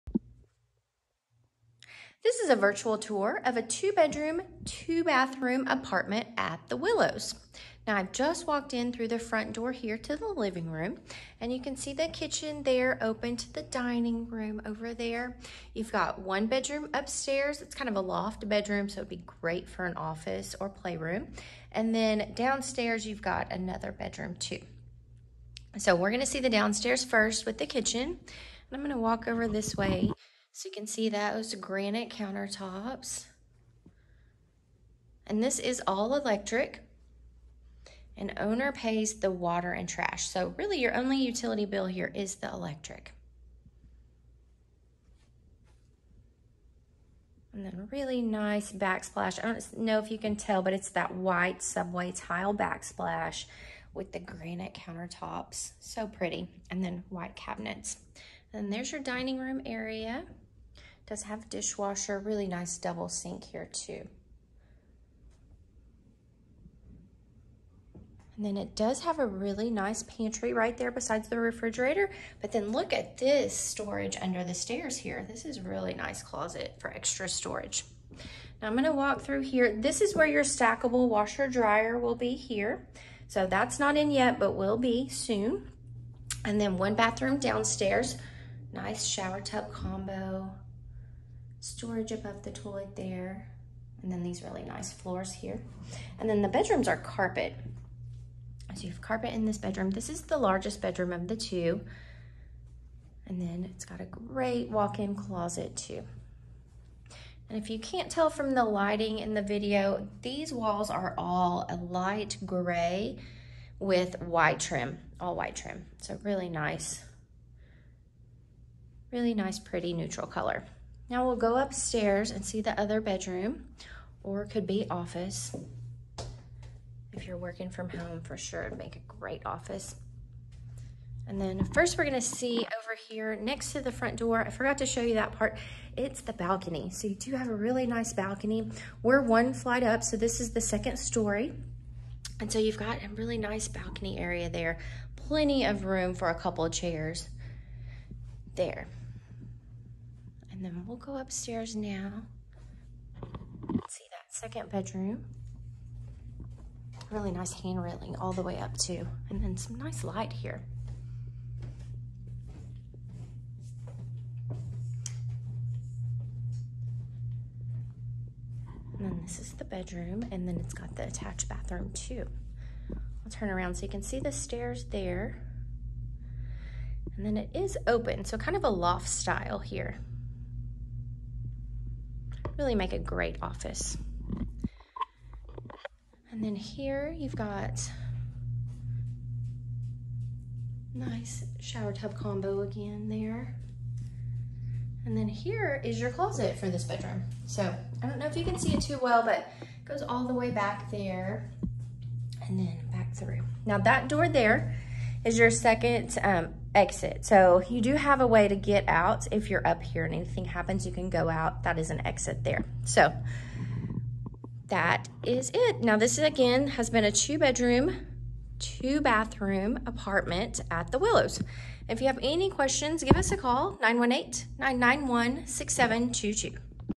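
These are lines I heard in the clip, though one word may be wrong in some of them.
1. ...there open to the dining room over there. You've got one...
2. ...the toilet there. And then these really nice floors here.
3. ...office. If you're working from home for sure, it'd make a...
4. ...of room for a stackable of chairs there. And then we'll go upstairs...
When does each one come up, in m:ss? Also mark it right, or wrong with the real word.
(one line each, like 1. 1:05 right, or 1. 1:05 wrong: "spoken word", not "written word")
1. 0:12 right
2. 1:32 right
3. 2:04 right
4. 2:25 wrong: "couple", not "stackable".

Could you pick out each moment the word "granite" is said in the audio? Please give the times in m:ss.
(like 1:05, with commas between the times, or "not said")
0:31, 0:54.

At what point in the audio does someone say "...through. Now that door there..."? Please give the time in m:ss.
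3:23.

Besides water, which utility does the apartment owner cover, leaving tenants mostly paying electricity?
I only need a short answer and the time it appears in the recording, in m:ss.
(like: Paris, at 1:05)
Trash, at 0:39.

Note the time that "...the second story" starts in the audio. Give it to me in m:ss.
2:20.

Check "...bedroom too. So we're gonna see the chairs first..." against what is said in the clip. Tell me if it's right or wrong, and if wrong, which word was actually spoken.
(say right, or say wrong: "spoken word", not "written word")
wrong: "downstairs", not "chairs".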